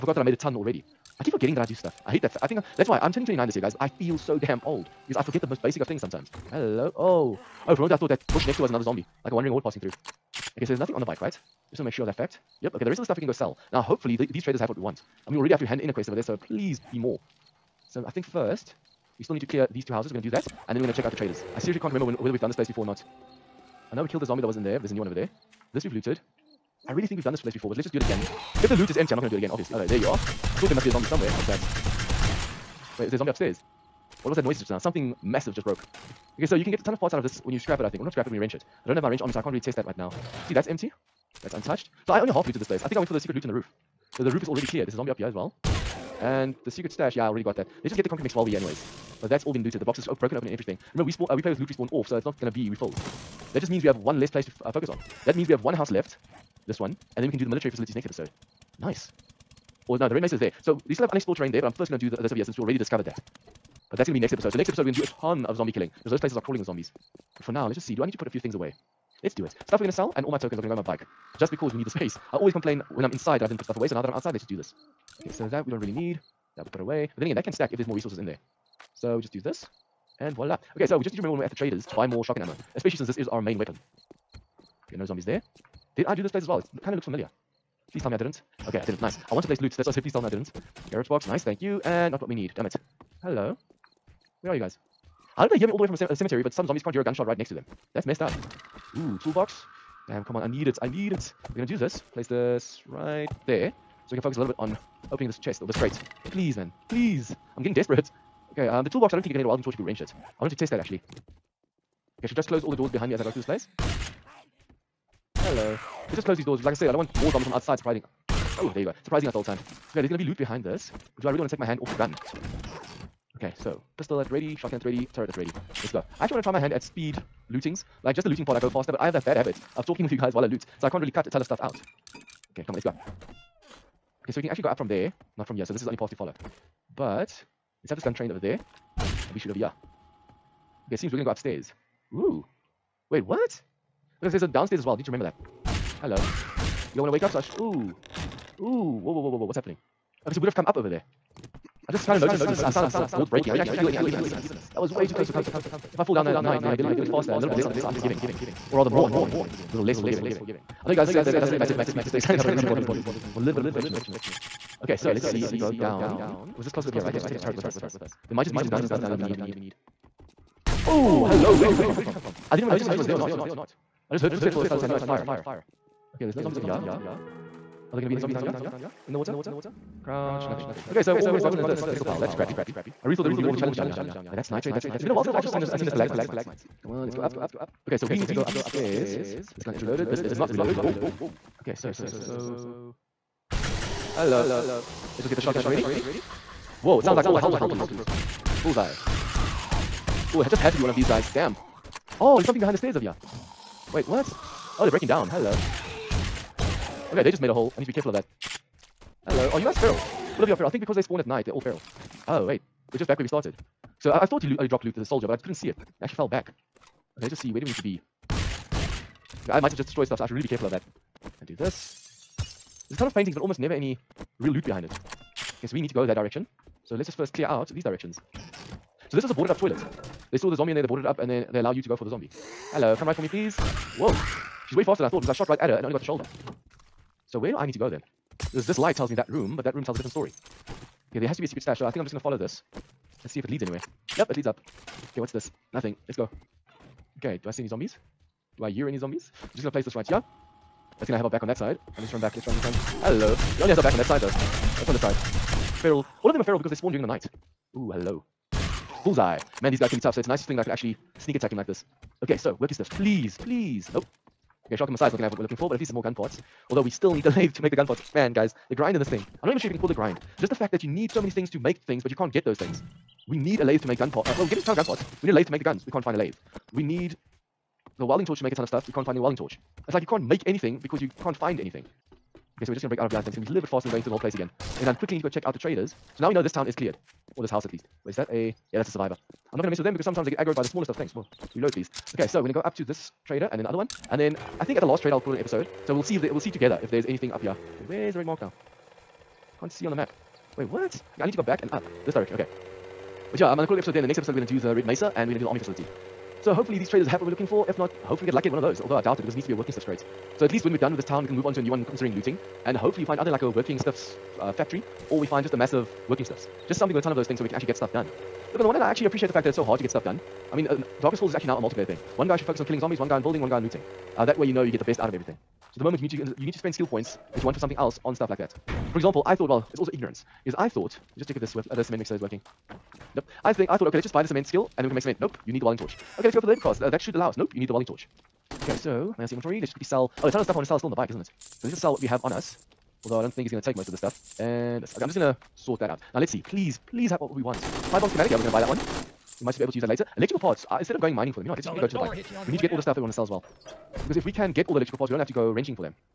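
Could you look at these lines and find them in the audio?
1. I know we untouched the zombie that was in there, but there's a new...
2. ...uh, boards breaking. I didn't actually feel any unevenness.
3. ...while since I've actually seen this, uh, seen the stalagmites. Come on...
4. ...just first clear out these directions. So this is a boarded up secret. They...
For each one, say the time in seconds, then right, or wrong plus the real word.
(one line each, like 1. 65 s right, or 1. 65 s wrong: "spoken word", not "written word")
1. 23 s wrong: "killed", not "untouched"
2. 152 s right
3. 185 s right
4. 227 s wrong: "toilet", not "secret".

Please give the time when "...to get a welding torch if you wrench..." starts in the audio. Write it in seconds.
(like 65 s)
109 s.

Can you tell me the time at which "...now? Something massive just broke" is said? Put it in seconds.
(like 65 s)
34 s.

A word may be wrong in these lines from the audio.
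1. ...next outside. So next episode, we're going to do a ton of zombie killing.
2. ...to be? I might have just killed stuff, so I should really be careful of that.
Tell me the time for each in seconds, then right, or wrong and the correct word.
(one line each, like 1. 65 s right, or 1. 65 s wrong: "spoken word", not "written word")
1. 64 s wrong: "episode", not "outside"
2. 217 s wrong: "destroyed", not "killed".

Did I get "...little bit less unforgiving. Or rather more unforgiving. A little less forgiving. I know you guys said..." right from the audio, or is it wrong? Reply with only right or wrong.
right.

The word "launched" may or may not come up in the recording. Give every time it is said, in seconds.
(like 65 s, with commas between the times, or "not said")
not said.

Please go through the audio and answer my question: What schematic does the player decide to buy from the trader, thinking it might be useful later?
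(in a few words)
Bomb schematic.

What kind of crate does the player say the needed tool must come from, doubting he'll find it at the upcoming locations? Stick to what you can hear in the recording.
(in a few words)
Working Stiff.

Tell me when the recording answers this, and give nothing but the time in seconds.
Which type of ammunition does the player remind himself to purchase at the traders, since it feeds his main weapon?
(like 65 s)
82 s.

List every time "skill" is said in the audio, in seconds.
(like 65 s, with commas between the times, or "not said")
326 s, 334 s.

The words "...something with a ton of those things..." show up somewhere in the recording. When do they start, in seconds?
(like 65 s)
316 s.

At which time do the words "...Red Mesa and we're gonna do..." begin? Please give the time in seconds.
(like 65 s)
304 s.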